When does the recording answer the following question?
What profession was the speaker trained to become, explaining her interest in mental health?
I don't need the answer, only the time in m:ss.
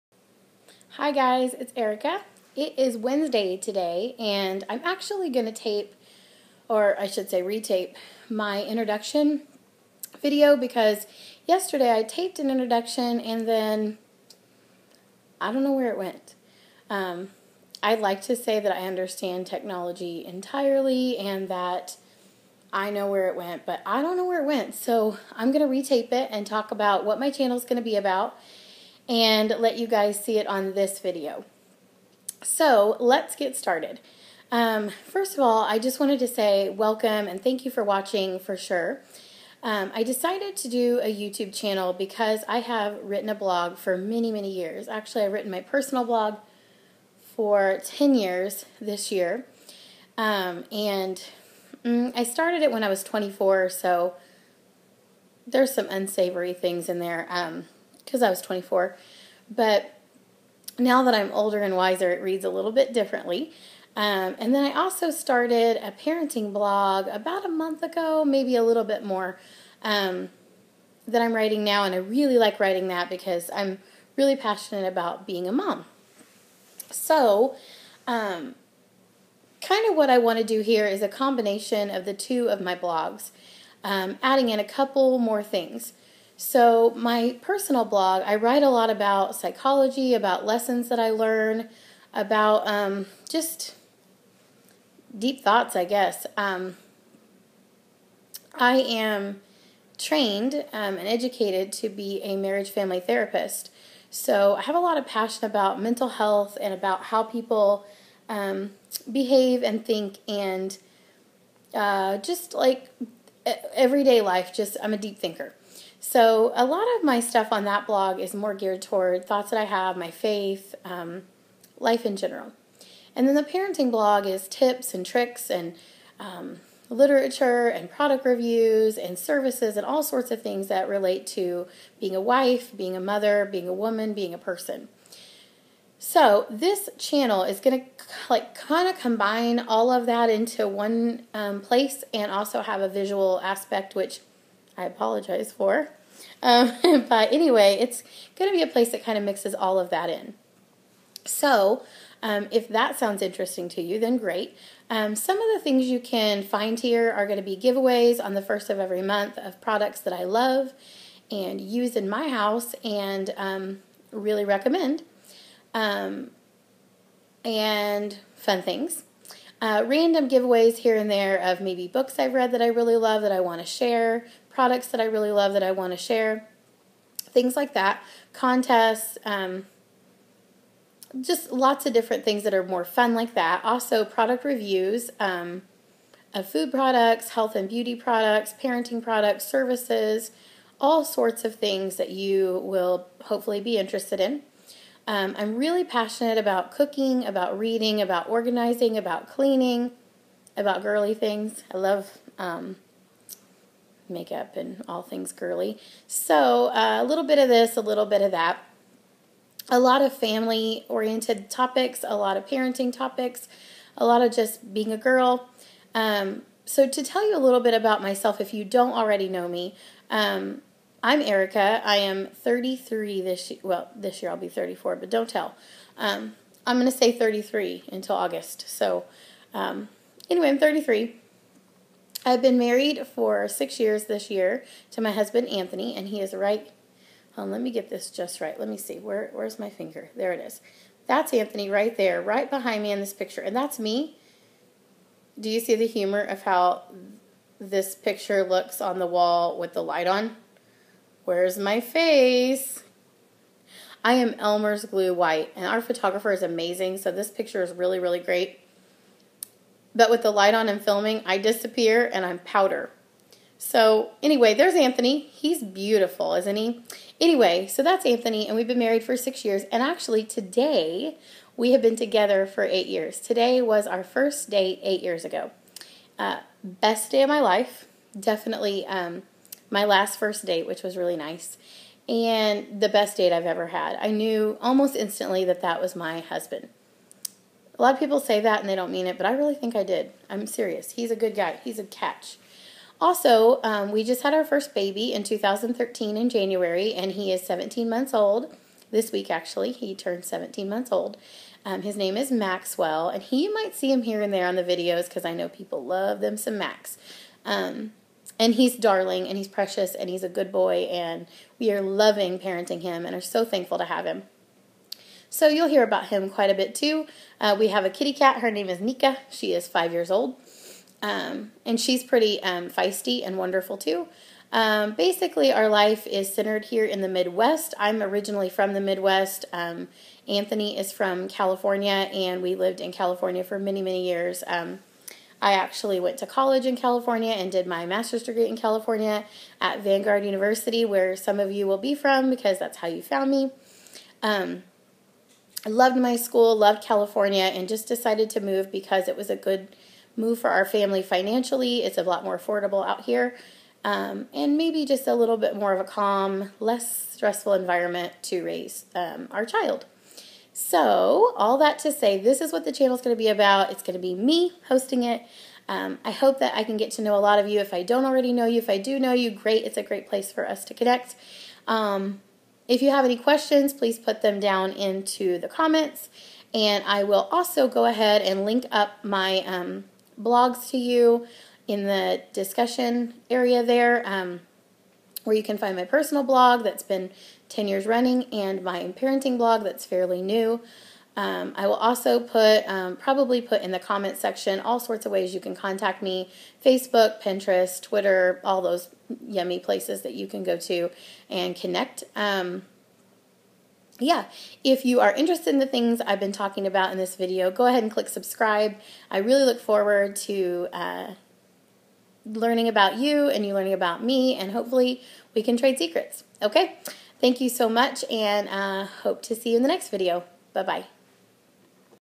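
1:42.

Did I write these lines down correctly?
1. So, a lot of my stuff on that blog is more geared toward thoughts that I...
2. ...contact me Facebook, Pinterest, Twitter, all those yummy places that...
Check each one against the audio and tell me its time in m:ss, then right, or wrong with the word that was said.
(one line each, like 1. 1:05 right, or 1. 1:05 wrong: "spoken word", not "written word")
1. 1:56 right
2. 6:35 right.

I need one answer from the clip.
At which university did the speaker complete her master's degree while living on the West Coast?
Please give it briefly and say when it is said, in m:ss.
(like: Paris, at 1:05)
Vanguard University, at 5:39.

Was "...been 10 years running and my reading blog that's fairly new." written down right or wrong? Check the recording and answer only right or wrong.
wrong.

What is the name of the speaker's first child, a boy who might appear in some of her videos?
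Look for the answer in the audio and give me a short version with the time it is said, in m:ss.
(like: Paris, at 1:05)
Maxwell, at 5:02.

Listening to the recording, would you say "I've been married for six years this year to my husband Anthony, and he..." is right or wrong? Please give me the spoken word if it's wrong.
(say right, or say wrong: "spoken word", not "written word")
right.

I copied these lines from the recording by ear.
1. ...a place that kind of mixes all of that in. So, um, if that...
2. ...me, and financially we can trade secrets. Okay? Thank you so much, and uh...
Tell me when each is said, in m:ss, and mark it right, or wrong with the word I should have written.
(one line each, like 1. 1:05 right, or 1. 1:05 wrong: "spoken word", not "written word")
1. 2:28 right
2. 6:54 wrong: "hopefully", not "financially".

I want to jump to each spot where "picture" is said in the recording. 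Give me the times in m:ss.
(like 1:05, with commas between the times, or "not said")
4:03, 4:07, 4:17.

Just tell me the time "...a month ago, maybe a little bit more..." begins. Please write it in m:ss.
1:07.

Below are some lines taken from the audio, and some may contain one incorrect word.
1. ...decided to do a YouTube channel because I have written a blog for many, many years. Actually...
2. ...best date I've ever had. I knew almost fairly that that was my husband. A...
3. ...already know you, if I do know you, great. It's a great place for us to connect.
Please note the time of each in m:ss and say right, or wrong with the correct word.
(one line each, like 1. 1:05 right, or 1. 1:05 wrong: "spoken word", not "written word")
1. 0:40 right
2. 4:42 wrong: "instantly", not "fairly"
3. 6:08 right.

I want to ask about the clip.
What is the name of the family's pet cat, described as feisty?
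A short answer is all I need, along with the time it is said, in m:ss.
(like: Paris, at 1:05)
Nika, at 5:18.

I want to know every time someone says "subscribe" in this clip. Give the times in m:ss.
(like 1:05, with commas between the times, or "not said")
6:48.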